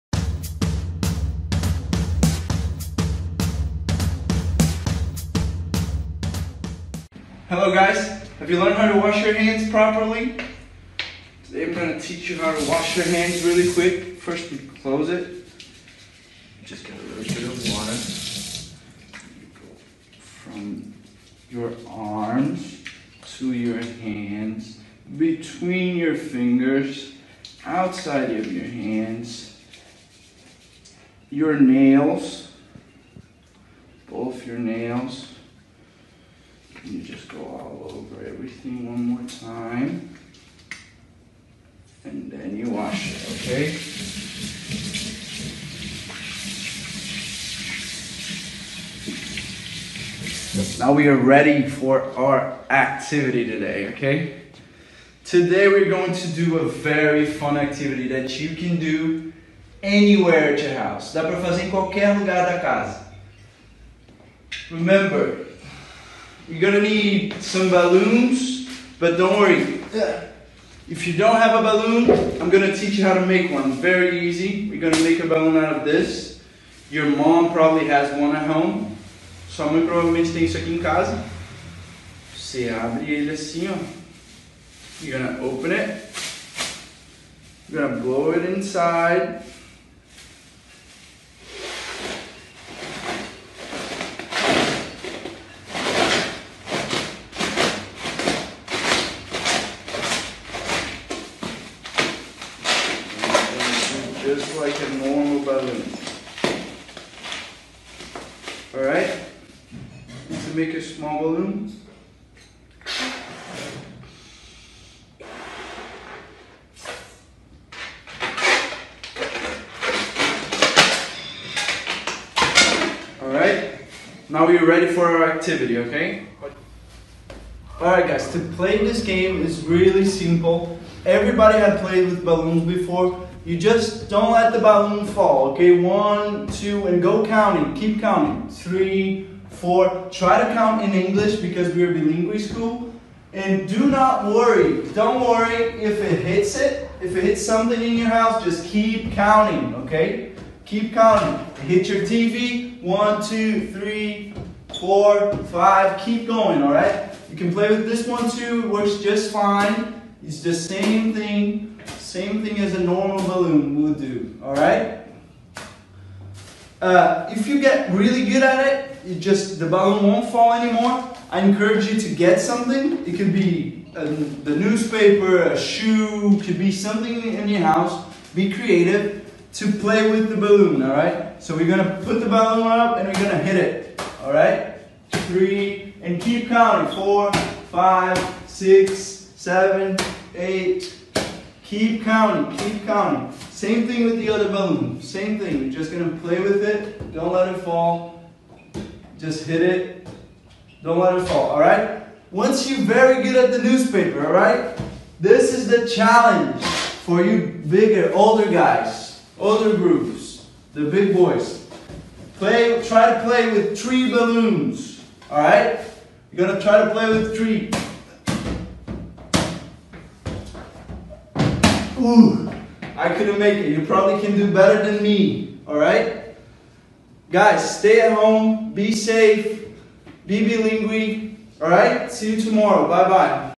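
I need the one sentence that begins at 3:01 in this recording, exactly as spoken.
So we're gonna put the balloon up and we're gonna hit it, all right?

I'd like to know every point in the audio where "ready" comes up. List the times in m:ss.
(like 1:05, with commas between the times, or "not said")
0:51, 2:04.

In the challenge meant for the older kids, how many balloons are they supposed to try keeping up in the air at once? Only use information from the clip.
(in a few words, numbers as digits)
3.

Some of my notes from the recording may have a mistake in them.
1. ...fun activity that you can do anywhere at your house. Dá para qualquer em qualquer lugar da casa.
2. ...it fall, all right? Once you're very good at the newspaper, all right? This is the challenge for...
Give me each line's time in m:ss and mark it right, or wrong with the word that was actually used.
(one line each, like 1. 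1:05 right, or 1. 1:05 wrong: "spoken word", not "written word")
1. 0:57 wrong: "fazer", not "qualquer"
2. 3:21 right.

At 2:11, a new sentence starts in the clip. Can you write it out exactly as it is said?
Everybody had played with balloons before.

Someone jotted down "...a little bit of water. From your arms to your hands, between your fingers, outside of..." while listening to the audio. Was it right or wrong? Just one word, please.
right.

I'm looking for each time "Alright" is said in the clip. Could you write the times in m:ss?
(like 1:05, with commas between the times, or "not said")
1:48, 2:03, 2:07.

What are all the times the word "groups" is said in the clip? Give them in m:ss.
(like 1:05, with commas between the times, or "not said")
3:29.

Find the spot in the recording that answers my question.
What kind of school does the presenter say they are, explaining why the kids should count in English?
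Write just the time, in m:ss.
2:21.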